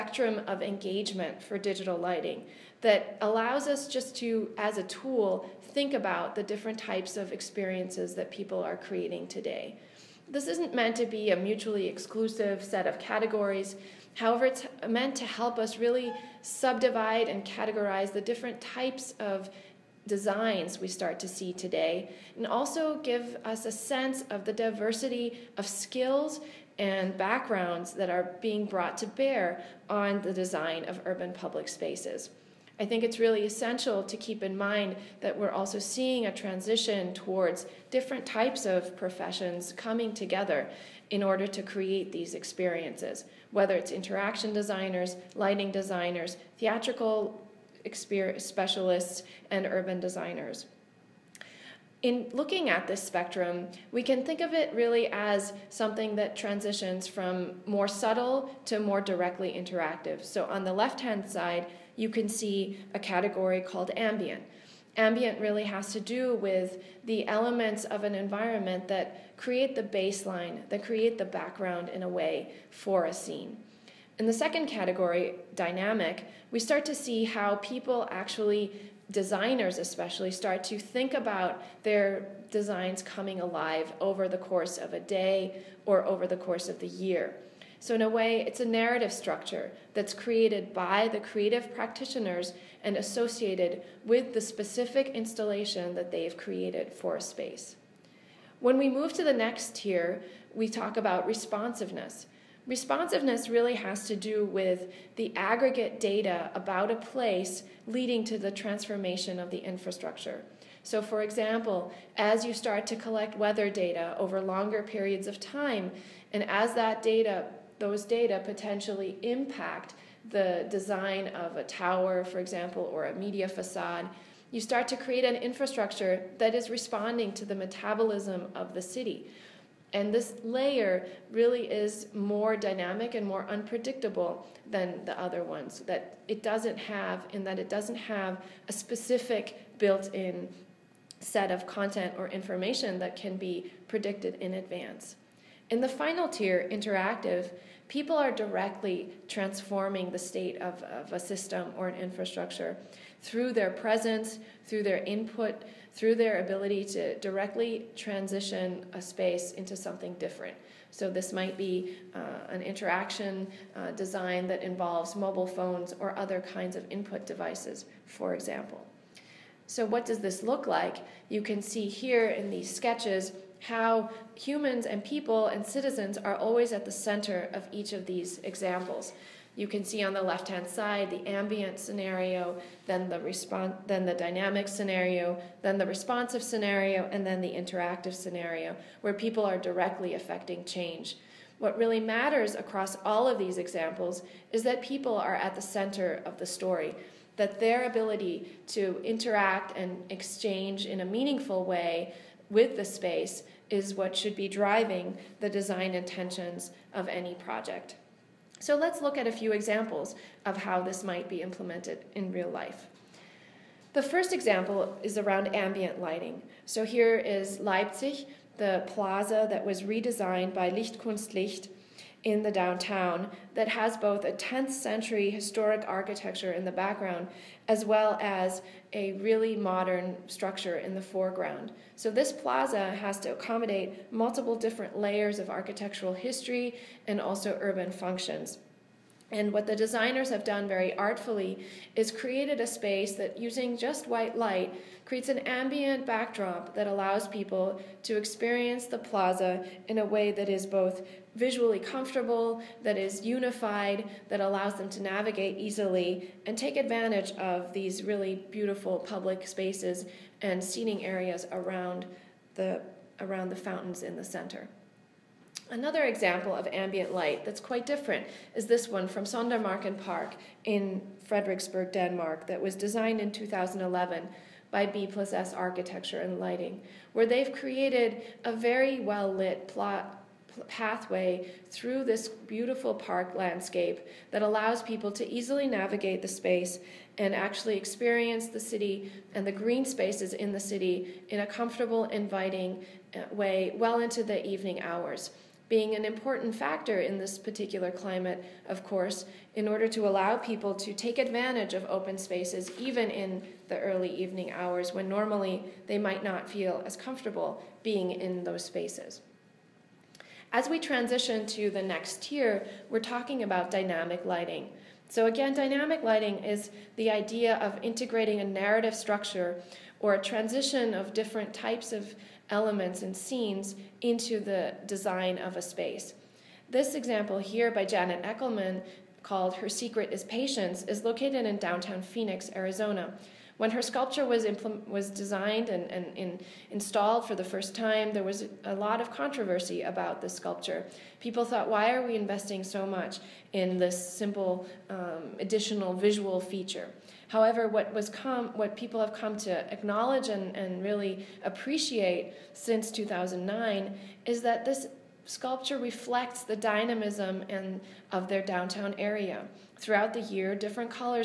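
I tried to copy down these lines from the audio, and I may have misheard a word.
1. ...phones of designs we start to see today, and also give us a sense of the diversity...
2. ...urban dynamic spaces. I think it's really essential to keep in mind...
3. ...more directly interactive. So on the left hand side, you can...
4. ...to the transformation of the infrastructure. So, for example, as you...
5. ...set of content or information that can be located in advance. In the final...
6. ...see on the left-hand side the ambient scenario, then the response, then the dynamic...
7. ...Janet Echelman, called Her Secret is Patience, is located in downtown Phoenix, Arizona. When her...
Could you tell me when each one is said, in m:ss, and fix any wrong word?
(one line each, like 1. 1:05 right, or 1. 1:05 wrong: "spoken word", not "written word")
1. 0:18 wrong: "types", not "phones"
2. 0:31 wrong: "public", not "dynamic"
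3. 0:58 right
4. 1:48 right
5. 2:21 wrong: "predicted", not "located"
6. 2:59 right
7. 5:27 right.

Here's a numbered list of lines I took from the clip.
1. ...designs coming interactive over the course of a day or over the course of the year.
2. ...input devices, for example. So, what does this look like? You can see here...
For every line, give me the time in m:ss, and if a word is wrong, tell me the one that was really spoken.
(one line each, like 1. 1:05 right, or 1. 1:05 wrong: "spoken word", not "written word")
1. 1:22 wrong: "alive", not "interactive"
2. 2:46 right.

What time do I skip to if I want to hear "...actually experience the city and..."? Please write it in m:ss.
4:47.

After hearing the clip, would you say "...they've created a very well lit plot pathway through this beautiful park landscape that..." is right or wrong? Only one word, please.
right.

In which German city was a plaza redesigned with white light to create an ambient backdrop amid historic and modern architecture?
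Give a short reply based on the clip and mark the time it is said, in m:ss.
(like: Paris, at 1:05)
Leipzig, at 3:37.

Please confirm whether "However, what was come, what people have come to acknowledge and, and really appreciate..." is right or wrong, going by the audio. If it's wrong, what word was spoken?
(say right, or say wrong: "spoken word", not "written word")
right.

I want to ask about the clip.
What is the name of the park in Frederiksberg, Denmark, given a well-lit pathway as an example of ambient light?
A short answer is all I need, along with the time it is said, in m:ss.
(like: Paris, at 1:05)
Sondermarken Park, at 4:29.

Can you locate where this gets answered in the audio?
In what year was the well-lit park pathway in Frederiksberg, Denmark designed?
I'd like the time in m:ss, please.
4:33.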